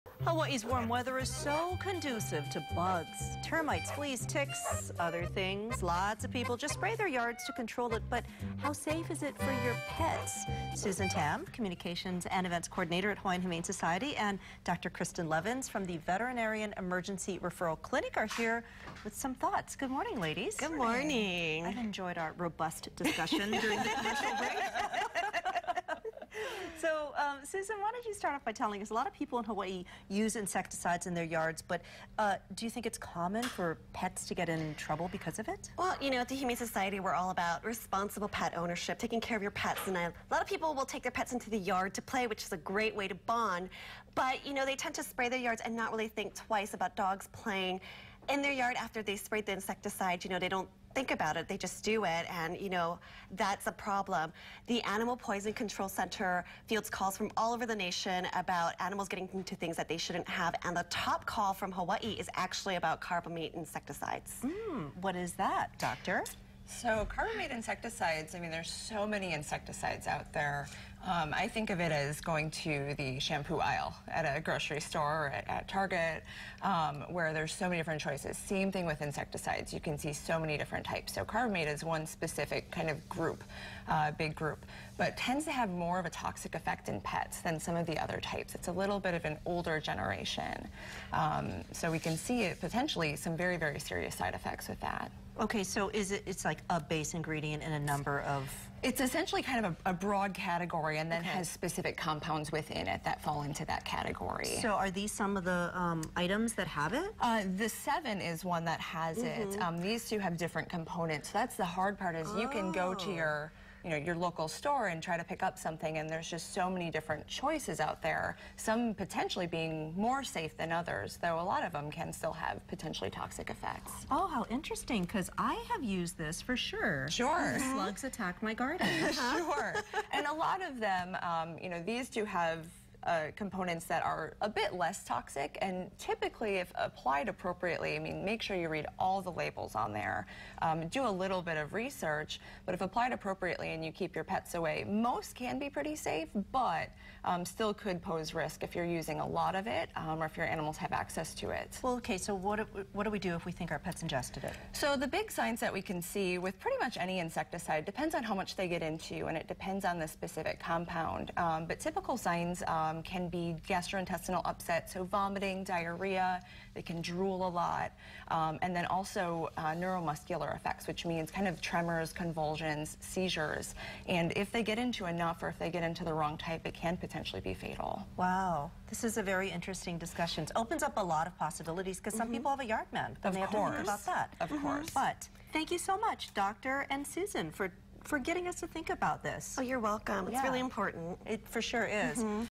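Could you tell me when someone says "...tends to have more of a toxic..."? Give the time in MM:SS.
01:25.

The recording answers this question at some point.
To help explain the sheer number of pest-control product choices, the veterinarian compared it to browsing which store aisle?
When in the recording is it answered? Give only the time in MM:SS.
01:13.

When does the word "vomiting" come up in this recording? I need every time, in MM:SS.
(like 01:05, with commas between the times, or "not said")
02:45.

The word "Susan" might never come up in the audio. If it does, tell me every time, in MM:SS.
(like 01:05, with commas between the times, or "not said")
00:10, 00:27, 03:07.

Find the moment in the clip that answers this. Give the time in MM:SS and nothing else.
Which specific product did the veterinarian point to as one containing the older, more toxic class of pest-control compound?
01:47.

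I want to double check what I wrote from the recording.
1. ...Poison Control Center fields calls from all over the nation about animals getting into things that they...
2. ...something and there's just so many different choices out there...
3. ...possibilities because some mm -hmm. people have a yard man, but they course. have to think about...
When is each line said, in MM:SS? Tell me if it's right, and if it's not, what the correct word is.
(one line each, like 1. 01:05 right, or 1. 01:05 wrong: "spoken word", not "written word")
1. 00:55 right
2. 01:55 right
3. 03:01 right.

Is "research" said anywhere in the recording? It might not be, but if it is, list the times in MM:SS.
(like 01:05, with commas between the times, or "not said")
02:21.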